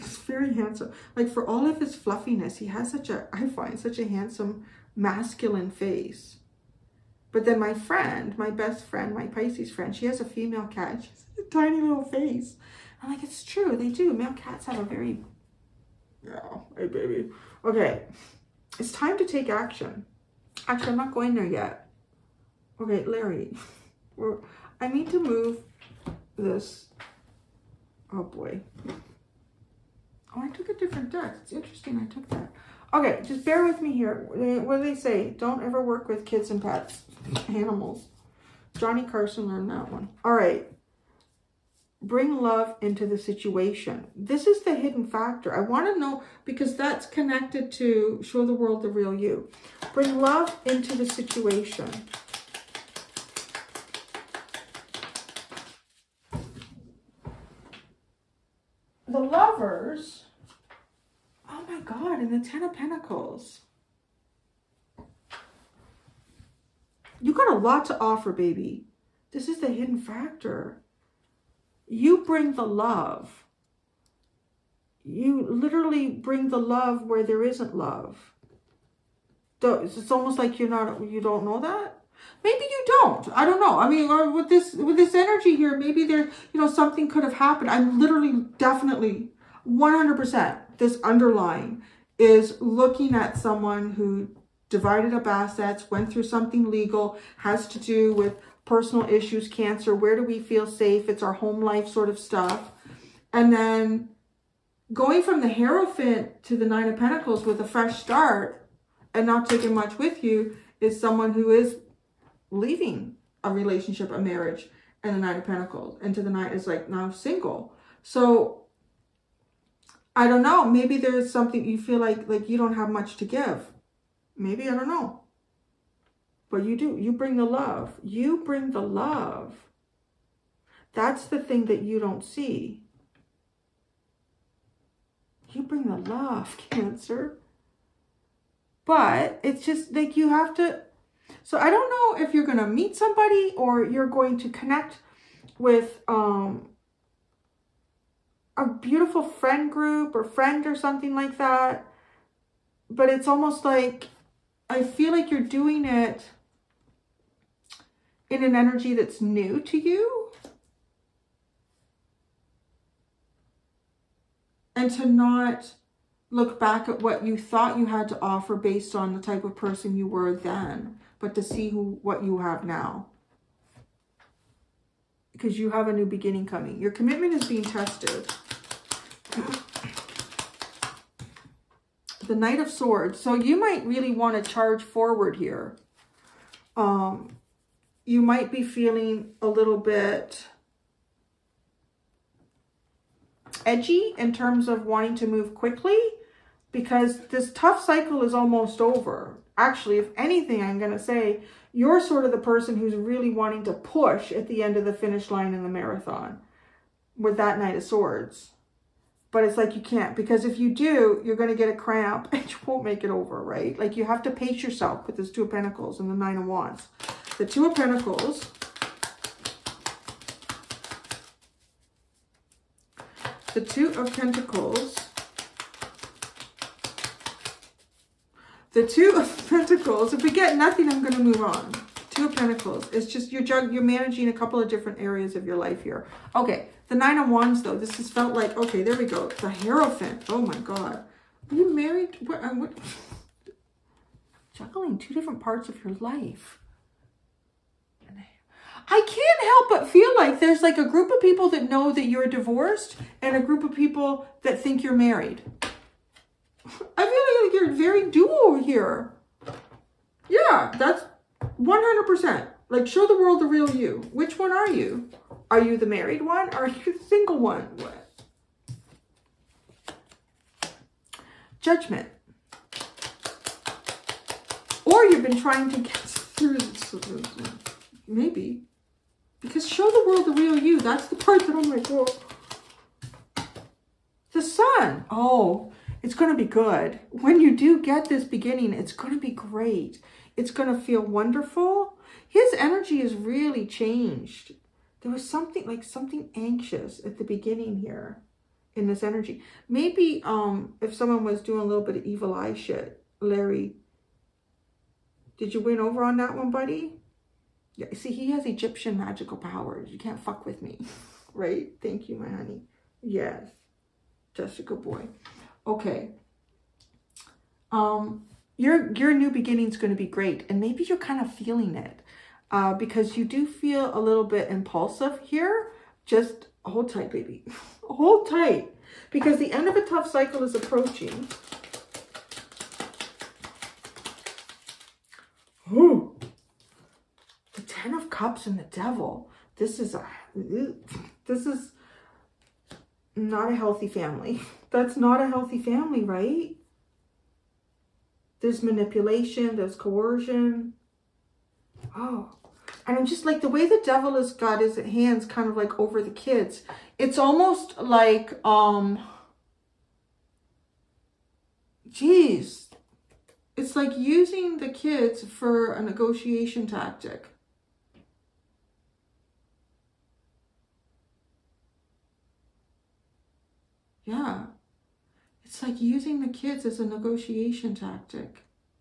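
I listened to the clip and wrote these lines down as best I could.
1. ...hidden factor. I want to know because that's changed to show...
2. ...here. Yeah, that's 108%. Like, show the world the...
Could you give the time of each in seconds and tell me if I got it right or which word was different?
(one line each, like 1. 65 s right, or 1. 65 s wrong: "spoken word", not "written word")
1. 44 s wrong: "connected", not "changed"
2. 258 s wrong: "100", not "108".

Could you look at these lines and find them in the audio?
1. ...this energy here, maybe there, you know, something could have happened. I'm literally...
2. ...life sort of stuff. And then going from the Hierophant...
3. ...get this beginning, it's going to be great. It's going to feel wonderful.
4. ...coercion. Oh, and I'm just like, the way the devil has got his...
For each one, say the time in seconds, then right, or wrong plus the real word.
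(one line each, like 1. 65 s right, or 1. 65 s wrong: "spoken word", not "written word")
1. 84 s right
2. 101 s right
3. 287 s right
4. 349 s right.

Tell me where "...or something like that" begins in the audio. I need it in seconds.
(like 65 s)
150 s.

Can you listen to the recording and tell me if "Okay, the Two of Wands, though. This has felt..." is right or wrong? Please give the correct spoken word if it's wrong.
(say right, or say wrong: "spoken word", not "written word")
wrong: "Nine", not "Two".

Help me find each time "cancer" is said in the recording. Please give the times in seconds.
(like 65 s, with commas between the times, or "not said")
99 s, 136 s.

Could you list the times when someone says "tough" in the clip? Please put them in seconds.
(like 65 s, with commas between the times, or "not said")
197 s, 329 s.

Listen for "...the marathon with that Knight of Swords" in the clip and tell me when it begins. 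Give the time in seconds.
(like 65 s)
205 s.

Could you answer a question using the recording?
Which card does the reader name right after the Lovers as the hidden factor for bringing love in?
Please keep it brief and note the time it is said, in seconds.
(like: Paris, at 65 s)
Ten of Pentacles, at 62 s.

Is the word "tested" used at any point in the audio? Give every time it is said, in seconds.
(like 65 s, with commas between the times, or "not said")
177 s.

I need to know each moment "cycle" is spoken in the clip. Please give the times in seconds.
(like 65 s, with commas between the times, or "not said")
197 s, 330 s.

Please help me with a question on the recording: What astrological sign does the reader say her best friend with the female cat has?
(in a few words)
Pisces.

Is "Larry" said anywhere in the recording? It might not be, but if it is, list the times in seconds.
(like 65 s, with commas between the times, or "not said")
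23 s, 303 s.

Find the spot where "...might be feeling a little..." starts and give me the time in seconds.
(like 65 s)
188 s.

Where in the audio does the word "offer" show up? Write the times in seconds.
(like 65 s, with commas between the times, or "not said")
67 s, 168 s.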